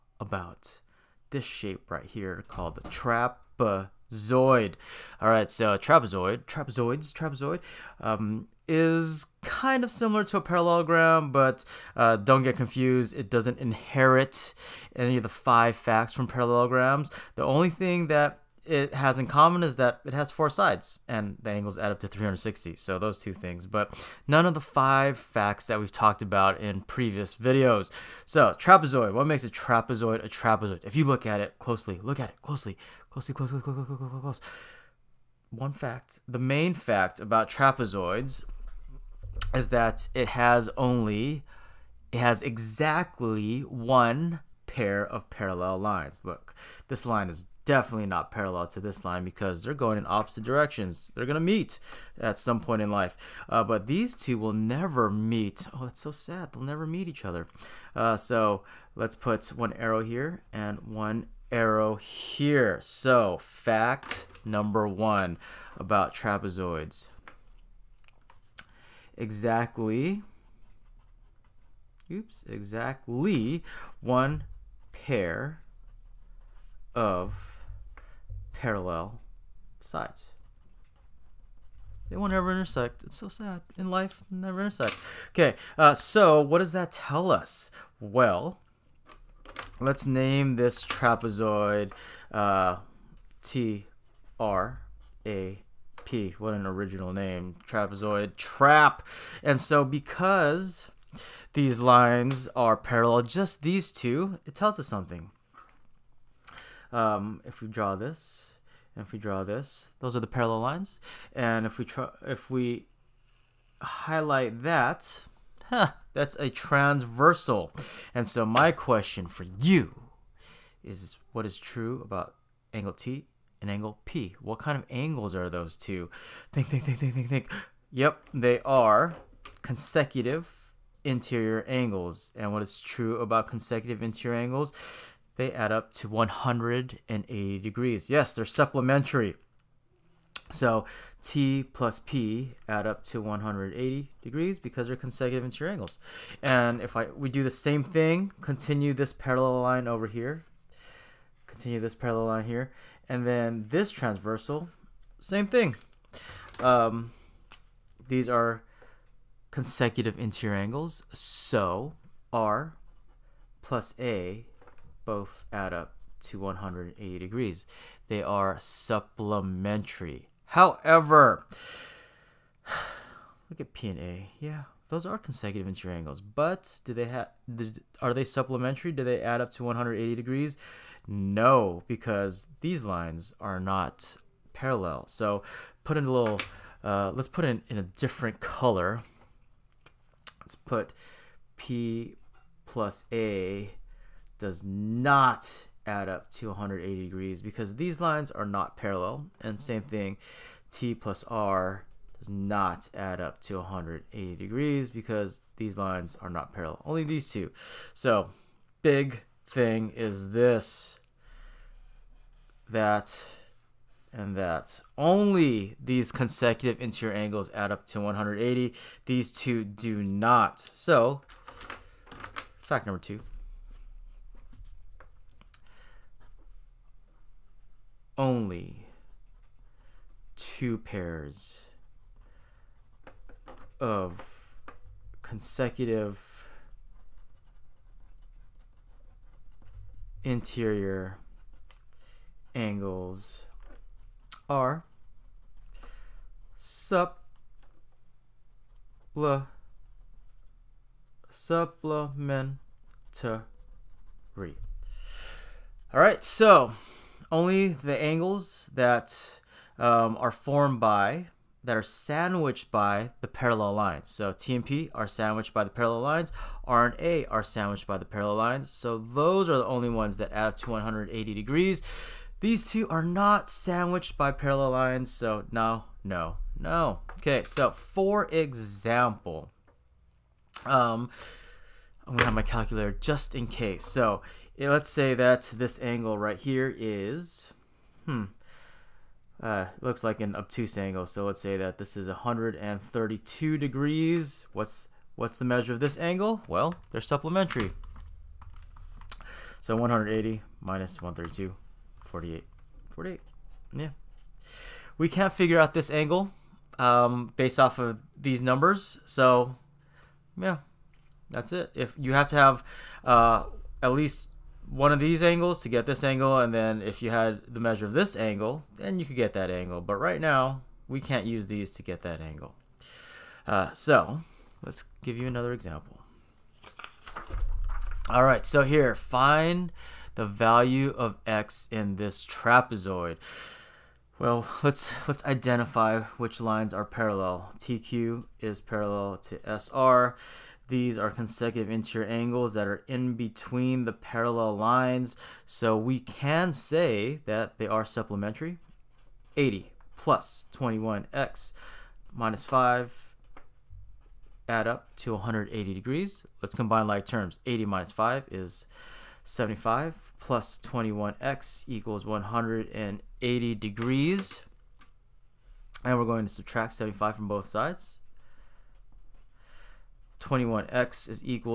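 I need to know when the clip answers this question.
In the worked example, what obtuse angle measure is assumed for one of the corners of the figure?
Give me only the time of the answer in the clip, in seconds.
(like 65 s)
292 s.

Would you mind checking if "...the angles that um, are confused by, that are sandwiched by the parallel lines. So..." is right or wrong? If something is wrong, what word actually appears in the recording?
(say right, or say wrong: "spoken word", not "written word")
wrong: "formed", not "confused".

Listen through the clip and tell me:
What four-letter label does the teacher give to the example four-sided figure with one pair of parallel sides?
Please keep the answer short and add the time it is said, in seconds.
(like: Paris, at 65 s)
TRAP, at 93 s.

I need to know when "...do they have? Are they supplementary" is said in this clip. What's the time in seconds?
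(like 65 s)
176 s.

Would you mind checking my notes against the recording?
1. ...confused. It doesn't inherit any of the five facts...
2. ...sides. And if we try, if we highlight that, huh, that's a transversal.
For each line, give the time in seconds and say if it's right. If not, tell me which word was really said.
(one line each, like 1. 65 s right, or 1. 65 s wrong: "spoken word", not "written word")
1. 12 s right
2. 110 s wrong: "lines", not "sides".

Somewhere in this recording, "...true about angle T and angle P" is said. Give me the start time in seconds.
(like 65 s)
121 s.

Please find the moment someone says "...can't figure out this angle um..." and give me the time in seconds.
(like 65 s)
305 s.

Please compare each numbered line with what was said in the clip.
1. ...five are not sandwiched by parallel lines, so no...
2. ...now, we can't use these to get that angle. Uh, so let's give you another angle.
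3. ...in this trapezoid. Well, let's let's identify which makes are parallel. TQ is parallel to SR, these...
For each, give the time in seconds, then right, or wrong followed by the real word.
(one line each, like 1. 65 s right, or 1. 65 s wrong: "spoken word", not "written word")
1. 272 s wrong: "two", not "five"
2. 320 s wrong: "example", not "angle"
3. 331 s wrong: "lines", not "makes".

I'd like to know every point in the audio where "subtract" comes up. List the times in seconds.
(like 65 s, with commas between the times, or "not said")
366 s.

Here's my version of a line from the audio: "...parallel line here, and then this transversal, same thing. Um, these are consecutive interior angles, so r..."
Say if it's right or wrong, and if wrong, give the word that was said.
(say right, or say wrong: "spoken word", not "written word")
right.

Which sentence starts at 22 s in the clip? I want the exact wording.
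So those two things, but none of the five facts that we've talked about in previous videos.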